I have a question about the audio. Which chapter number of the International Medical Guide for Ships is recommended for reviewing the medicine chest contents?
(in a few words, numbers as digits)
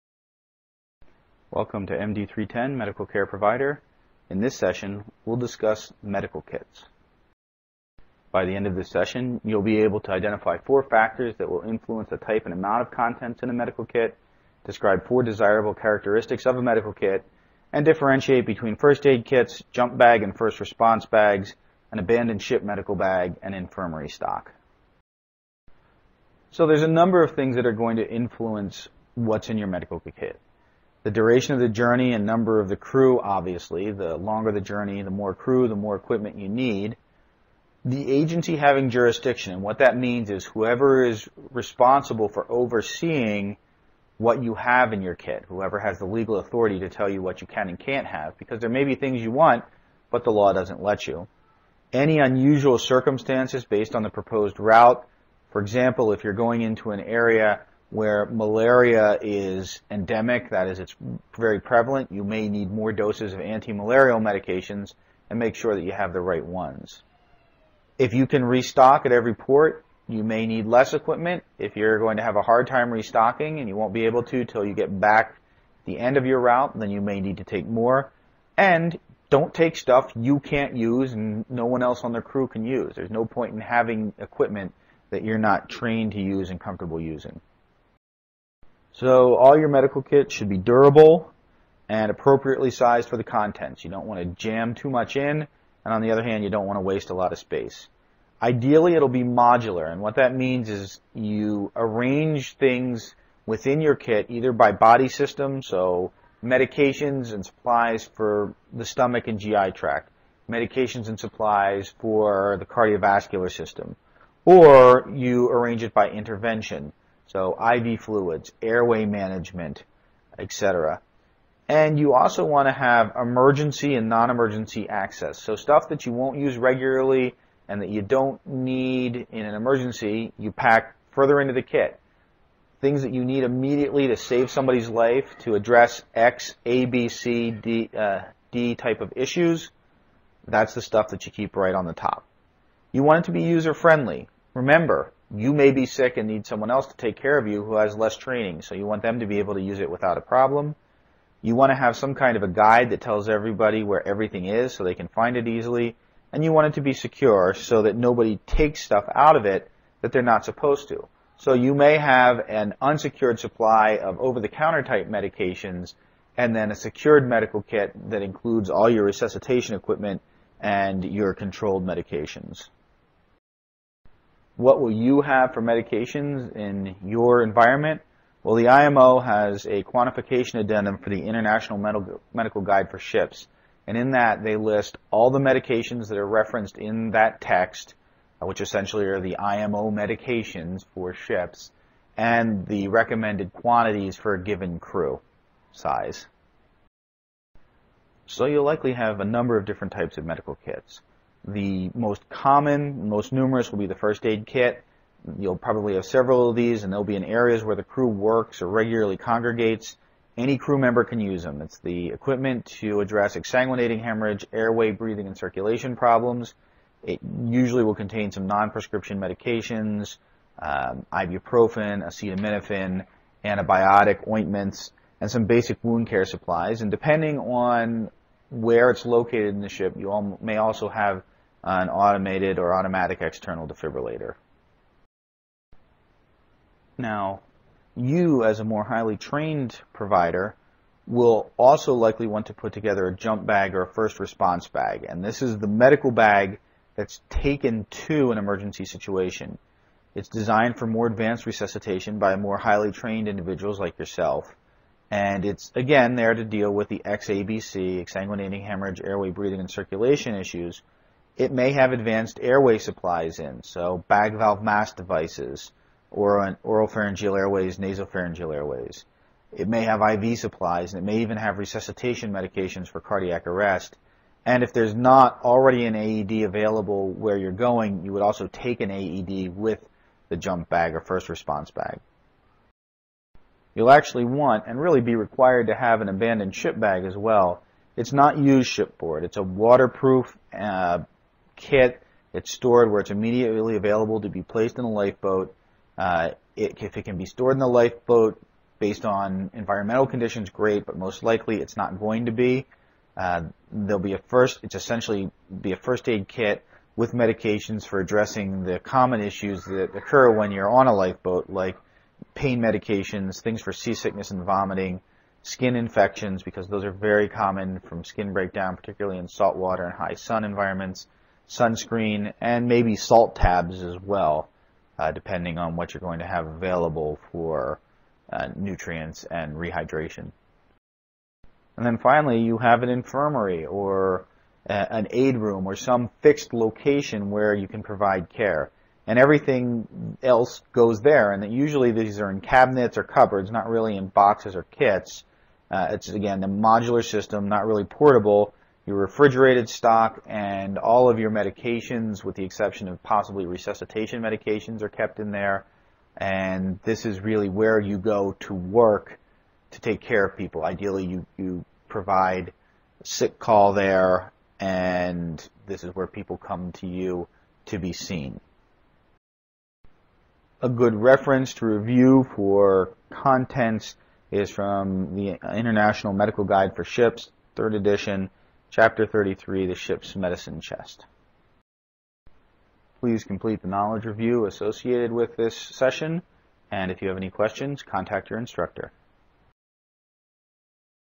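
33.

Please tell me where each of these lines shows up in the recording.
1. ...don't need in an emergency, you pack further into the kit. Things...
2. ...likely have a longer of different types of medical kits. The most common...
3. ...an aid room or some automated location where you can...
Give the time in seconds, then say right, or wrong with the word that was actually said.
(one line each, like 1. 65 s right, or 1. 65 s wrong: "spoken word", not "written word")
1. 128 s right
2. 198 s wrong: "number", not "longer"
3. 334 s wrong: "fixed", not "automated".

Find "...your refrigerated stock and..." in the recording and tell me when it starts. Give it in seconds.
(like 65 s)
348 s.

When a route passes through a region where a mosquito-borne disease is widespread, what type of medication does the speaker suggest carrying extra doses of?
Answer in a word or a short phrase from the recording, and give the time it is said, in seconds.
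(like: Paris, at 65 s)
anti-malarial medications, at 63 s.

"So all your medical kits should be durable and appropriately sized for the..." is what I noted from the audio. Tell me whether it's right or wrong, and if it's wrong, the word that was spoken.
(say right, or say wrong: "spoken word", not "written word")
right.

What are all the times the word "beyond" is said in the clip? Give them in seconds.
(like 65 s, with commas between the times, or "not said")
not said.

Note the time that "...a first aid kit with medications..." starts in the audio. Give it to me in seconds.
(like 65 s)
305 s.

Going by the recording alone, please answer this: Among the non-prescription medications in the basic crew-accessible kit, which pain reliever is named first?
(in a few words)
ibuprofen.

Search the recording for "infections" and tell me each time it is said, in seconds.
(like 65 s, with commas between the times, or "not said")
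315 s.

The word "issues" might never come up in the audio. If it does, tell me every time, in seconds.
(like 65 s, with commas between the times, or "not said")
139 s, 260 s, 309 s.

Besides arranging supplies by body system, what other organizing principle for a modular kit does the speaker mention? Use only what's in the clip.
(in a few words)
by intervention.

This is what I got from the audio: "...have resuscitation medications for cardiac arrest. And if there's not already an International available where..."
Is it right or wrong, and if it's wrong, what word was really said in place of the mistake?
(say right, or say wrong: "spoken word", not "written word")
wrong: "AED", not "International".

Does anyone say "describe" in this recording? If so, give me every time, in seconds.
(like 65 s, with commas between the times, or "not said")
14 s.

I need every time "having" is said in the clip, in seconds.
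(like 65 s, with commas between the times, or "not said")
38 s, 83 s.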